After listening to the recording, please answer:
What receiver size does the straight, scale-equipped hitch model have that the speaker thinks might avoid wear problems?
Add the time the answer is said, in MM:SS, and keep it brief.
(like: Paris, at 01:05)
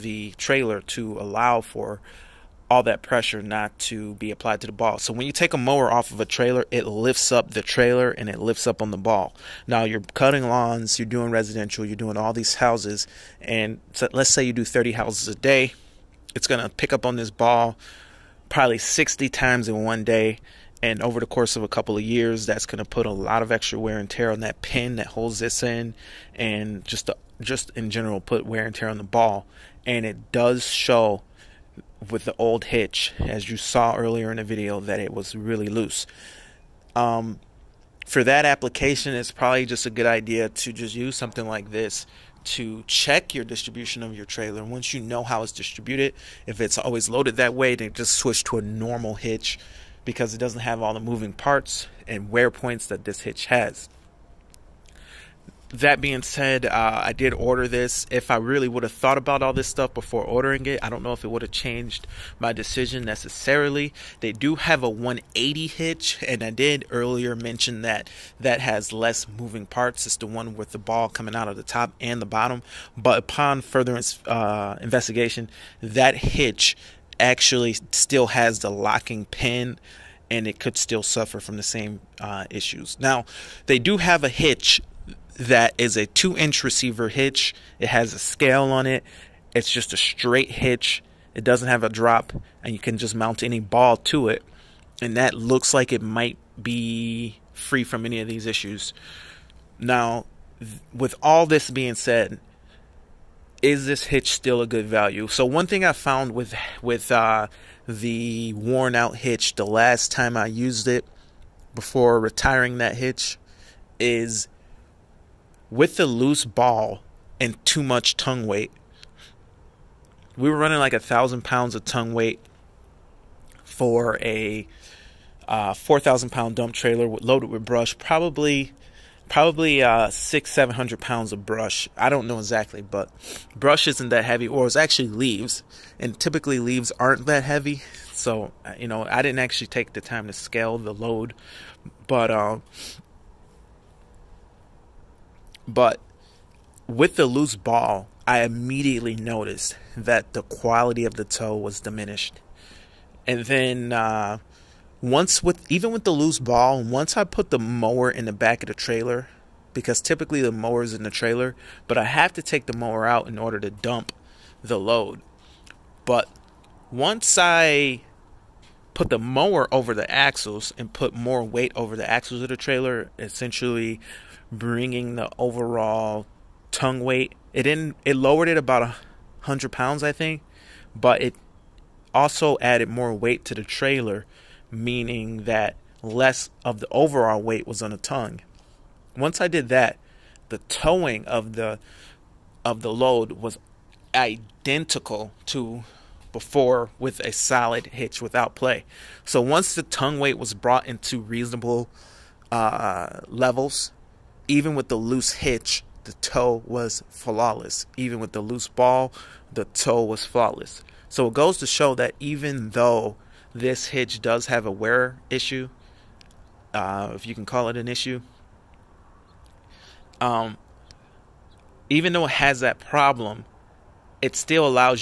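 2 inch, at 01:26.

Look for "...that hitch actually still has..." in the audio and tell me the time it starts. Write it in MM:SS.
01:15.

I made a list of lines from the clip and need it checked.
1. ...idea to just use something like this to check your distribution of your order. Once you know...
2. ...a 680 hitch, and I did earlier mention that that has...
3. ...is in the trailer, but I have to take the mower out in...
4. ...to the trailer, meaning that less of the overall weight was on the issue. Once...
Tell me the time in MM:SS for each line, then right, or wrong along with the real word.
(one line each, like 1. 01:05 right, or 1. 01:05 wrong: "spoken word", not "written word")
1. 00:40 wrong: "trailer", not "order"
2. 01:04 wrong: "180", not "680"
3. 02:40 right
4. 03:03 wrong: "tongue", not "issue".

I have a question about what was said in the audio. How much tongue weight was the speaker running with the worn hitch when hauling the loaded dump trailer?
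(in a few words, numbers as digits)
1000 pounds.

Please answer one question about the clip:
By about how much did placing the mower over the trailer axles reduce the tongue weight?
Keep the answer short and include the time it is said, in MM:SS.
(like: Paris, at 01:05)
100 pounds, at 02:58.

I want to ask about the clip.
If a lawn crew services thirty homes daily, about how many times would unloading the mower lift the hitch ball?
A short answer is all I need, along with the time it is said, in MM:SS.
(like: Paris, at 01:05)
60, at 00:18.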